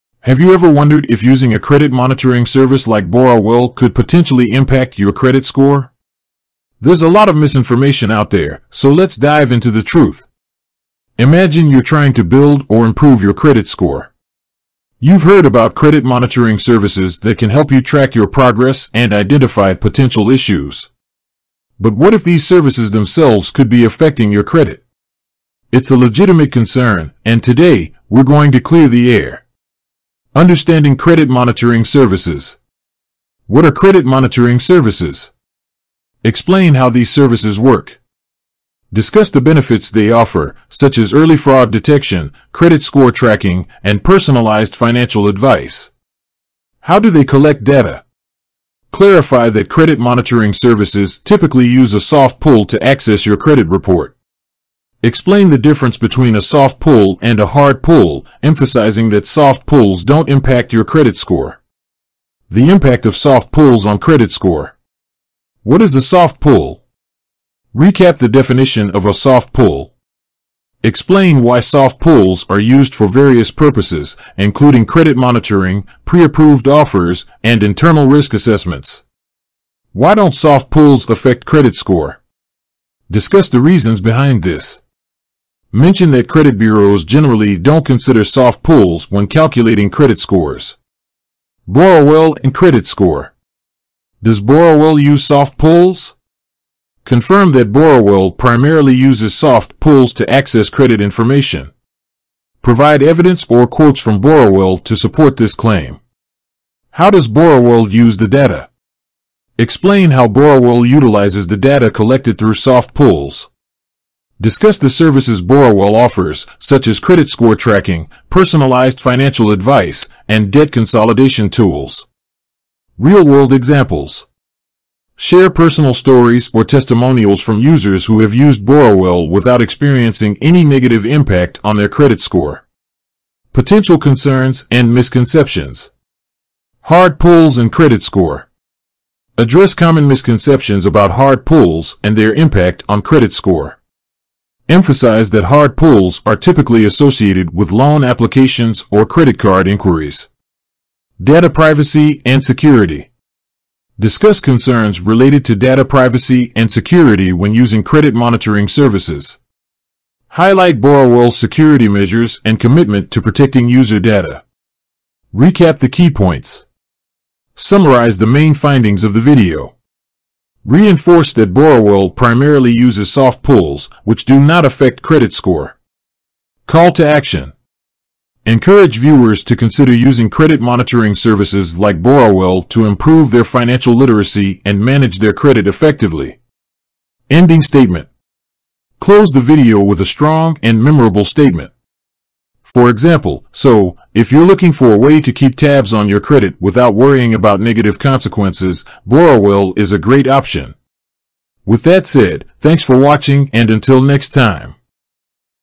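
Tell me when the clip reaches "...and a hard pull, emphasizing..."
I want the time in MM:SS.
00:57.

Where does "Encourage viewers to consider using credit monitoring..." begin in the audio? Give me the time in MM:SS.
02:58.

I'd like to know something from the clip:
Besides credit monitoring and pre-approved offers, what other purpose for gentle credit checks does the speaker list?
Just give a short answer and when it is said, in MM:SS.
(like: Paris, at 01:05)
internal risk assessments, at 01:17.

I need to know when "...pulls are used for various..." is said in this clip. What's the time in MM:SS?
01:11.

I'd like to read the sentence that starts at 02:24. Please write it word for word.
Emphasize that hard pulls are typically associated with loan applications or credit card inquiries.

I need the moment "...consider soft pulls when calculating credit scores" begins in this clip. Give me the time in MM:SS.
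01:27.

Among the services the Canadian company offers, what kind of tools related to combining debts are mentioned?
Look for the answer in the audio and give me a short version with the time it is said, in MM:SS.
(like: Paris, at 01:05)
debt consolidation tools, at 02:00.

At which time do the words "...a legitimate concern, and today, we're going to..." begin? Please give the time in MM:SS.
00:25.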